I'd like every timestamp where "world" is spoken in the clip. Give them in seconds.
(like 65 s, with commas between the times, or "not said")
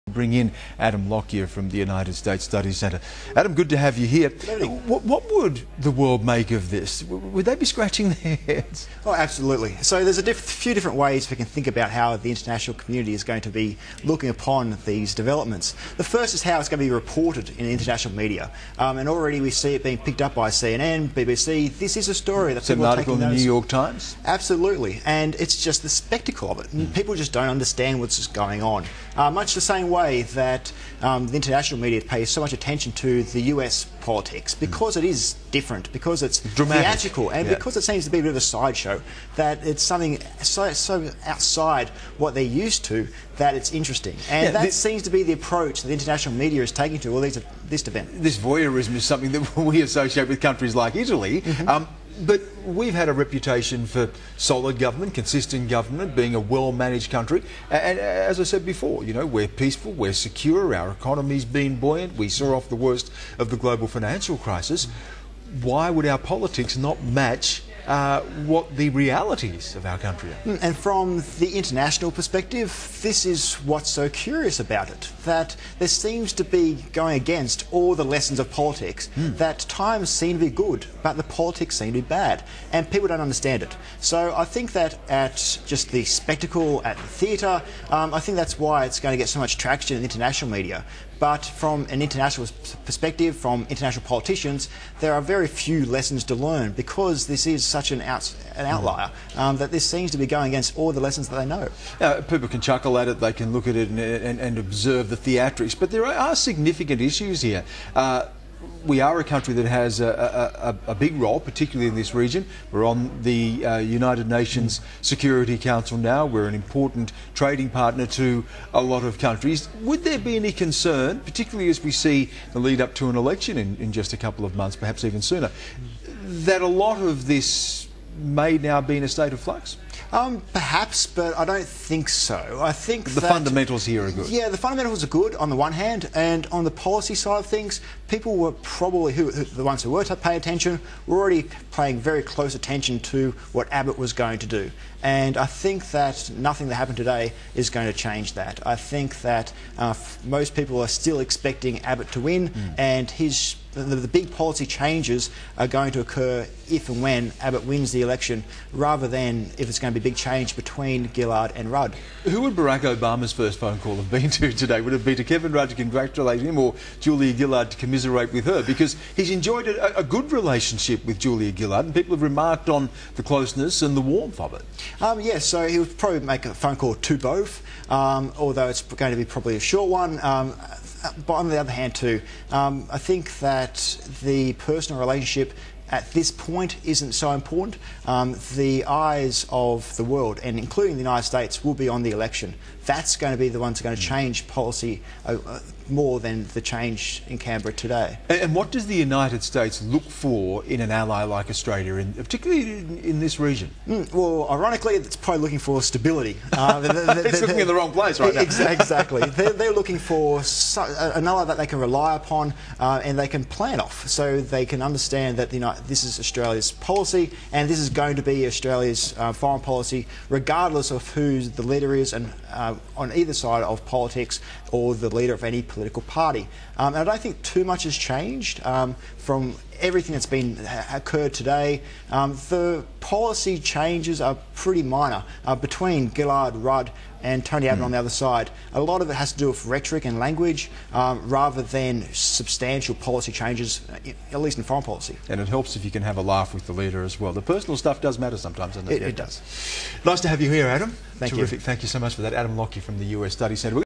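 5 s, 190 s.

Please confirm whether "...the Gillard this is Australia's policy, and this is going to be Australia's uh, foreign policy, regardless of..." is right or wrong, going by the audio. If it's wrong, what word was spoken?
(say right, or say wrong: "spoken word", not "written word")
wrong: "United", not "Gillard".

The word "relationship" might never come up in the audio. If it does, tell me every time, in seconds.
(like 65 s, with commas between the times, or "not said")
170 s, 184 s.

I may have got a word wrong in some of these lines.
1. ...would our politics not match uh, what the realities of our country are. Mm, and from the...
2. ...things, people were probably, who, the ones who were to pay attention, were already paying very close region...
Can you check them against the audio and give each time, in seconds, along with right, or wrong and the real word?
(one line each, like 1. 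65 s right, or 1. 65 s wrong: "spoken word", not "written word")
1. 65 s right
2. 137 s wrong: "attention", not "region".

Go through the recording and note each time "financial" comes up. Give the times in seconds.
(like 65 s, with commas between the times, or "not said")
63 s.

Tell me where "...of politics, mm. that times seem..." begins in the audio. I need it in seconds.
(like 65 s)
78 s.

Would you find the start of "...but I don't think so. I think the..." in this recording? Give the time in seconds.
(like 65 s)
131 s.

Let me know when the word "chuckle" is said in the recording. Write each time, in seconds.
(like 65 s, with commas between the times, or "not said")
102 s.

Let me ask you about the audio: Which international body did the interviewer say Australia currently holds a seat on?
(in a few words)
United Nations Security Council.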